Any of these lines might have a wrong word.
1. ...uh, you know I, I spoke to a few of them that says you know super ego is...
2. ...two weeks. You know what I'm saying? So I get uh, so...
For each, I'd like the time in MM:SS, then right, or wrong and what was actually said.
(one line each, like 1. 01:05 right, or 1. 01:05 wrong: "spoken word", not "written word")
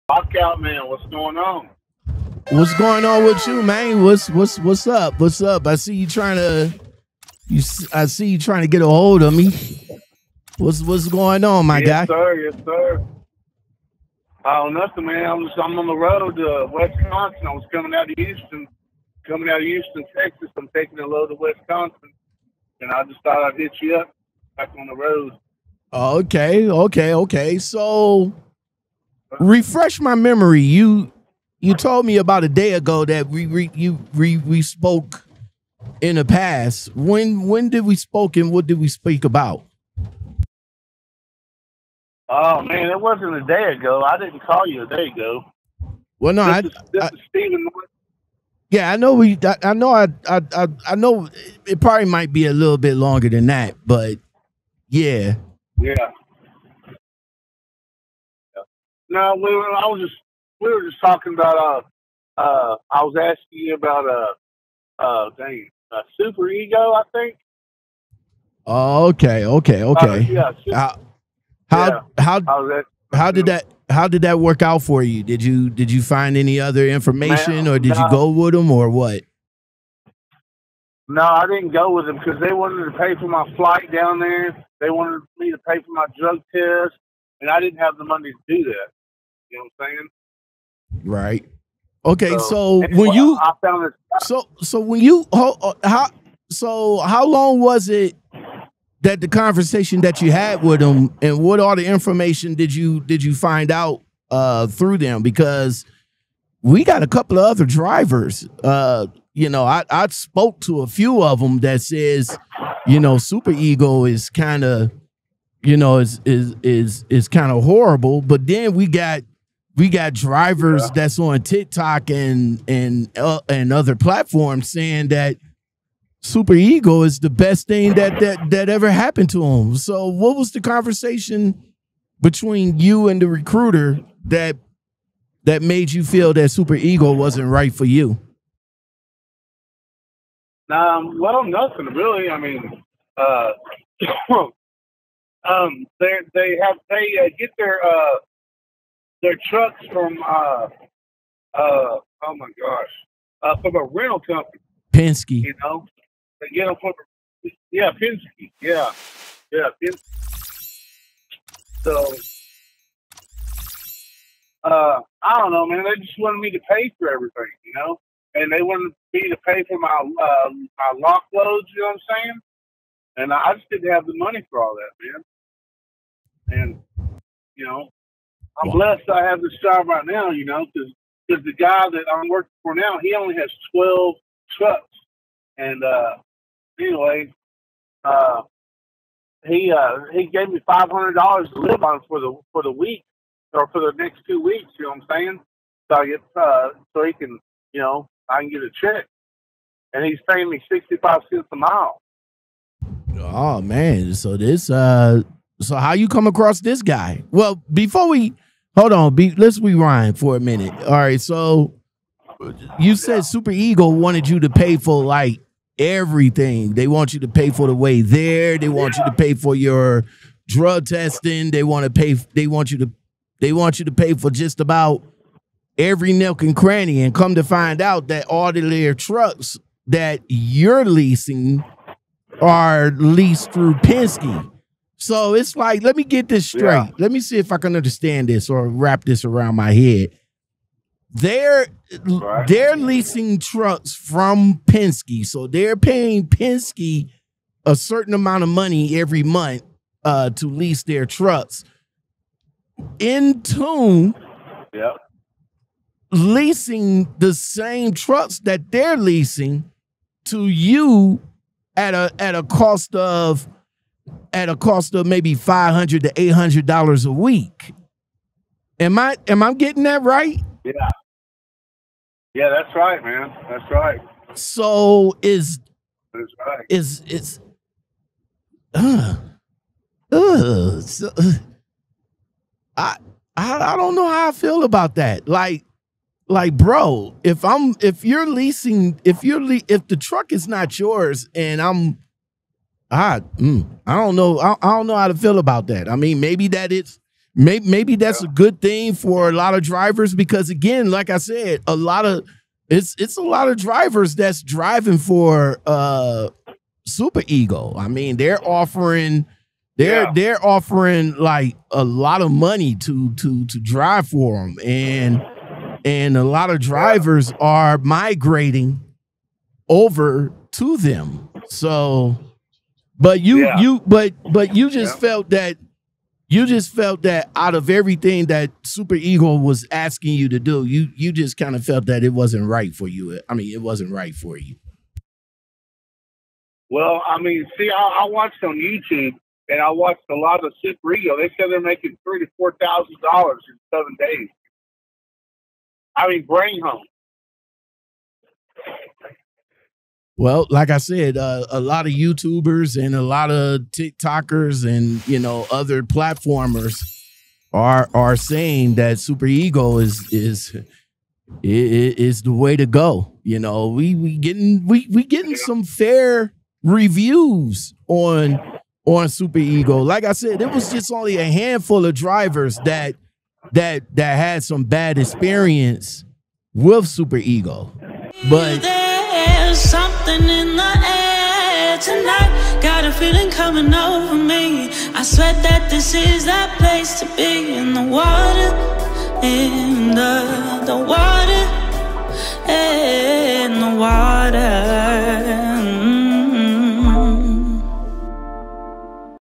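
1. 01:48 right
2. 03:14 right.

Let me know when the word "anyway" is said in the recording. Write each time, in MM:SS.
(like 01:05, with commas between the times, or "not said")
03:06.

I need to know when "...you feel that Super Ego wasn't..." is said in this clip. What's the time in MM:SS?
02:15.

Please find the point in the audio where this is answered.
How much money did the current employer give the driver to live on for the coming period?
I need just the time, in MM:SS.
03:10.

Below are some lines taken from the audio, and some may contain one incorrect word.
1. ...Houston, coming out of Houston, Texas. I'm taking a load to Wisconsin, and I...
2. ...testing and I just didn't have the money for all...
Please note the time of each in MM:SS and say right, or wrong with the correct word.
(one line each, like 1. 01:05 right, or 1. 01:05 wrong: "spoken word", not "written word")
1. 00:18 right
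2. 02:52 wrong: "saying", not "testing".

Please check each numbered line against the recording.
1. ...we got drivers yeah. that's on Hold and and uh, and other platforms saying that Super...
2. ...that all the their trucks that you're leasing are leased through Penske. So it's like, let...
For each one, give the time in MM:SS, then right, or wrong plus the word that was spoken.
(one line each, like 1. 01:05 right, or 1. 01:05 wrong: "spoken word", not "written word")
1. 01:59 wrong: "TikTok", not "Hold"
2. 03:48 right.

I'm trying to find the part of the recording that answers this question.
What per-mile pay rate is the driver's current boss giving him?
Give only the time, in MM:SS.
03:20.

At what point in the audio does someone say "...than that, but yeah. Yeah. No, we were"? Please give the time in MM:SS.
00:53.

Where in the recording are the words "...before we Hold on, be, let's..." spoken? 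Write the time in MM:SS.
03:27.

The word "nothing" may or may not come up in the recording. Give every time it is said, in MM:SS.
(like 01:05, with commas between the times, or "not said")
00:14, 02:21.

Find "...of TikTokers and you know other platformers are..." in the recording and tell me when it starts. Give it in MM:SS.
05:53.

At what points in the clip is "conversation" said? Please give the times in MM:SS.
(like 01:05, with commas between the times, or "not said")
01:39, 02:10.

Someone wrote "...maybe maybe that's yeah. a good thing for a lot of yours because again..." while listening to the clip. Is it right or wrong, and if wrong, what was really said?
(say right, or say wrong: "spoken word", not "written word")
wrong: "drivers", not "yours".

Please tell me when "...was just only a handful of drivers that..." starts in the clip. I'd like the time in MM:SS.
06:10.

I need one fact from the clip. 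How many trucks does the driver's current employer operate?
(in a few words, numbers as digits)
12.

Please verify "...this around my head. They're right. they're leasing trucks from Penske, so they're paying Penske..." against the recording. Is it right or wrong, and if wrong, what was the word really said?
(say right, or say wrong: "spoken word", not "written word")
right.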